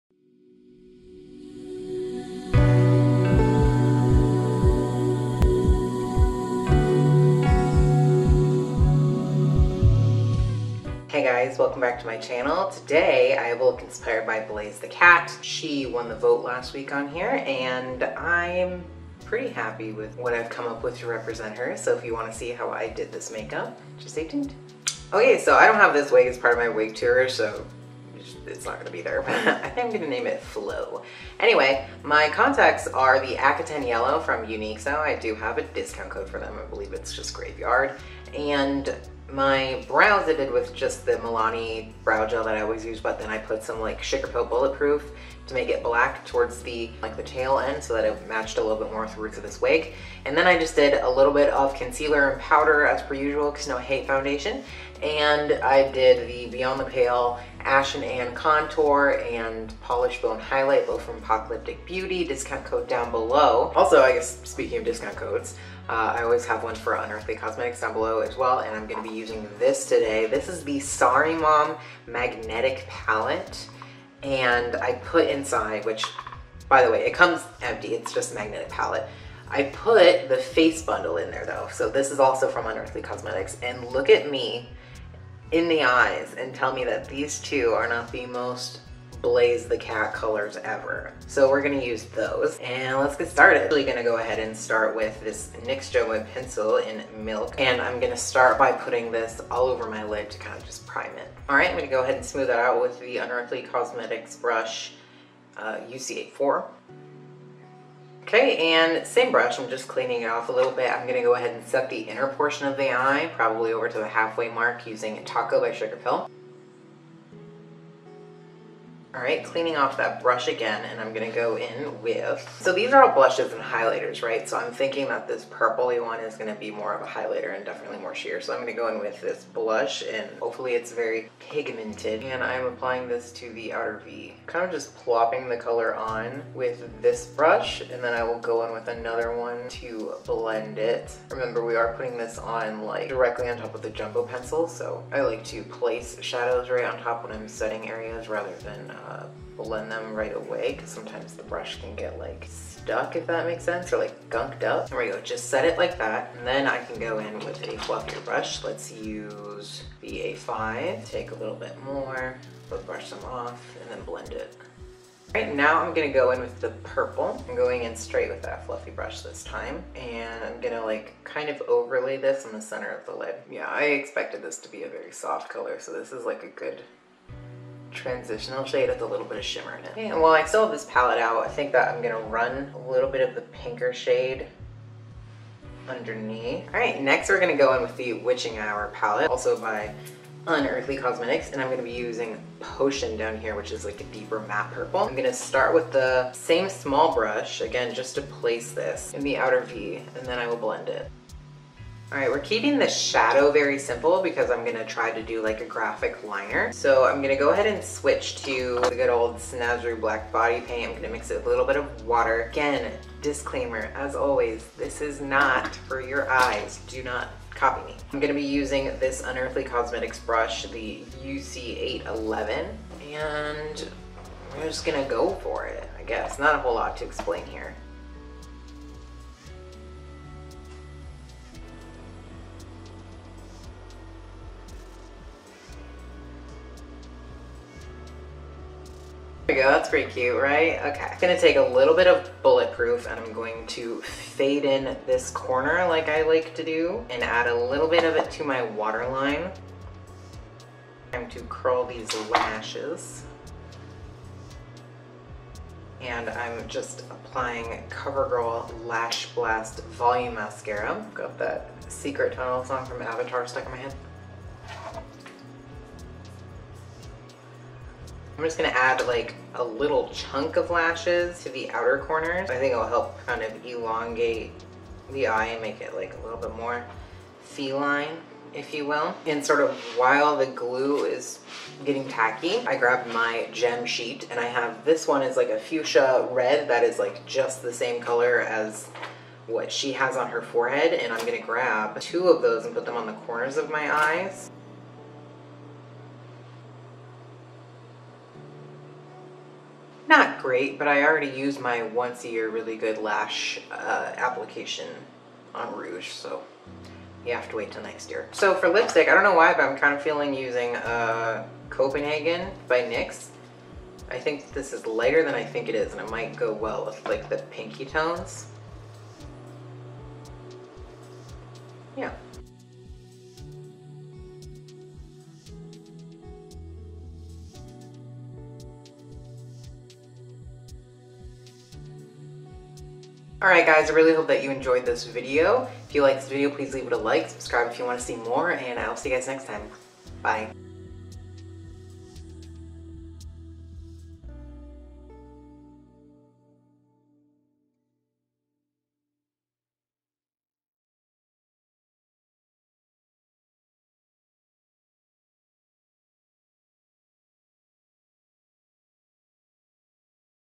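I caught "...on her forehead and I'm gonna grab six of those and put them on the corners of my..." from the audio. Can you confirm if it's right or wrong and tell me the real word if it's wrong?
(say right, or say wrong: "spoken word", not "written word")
wrong: "two", not "six".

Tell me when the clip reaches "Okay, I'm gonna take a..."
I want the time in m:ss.
4:00.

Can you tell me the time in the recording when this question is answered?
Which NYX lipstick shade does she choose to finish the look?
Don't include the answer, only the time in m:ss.
5:11.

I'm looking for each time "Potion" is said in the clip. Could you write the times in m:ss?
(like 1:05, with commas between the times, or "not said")
3:12.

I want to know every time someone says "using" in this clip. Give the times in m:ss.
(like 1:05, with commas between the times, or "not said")
1:09, 1:54, 3:11, 3:38, 5:10.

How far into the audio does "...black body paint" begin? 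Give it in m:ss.
3:29.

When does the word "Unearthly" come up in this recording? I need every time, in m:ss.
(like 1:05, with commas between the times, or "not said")
1:06, 1:22, 1:43, 3:10, 3:39.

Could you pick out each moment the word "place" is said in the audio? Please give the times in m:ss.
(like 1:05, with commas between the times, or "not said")
2:25, 3:18.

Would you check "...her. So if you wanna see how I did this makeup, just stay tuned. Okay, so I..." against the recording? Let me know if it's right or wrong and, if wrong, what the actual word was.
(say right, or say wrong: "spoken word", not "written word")
right.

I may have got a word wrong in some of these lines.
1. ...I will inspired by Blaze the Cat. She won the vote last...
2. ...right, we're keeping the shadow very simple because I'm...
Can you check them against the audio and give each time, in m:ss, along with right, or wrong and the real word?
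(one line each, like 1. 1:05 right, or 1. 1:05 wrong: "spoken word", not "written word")
1. 0:13 right
2. 3:22 right.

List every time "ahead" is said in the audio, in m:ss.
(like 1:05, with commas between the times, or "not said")
1:34, 1:42, 1:51, 3:27.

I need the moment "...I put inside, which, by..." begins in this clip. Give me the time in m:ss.
1:14.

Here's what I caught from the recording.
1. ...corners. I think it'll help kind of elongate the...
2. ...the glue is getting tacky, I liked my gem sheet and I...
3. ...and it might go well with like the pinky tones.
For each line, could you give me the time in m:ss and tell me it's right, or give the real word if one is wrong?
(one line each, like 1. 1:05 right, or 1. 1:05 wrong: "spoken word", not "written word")
1. 4:32 right
2. 4:40 wrong: "grabbed", not "liked"
3. 5:15 right.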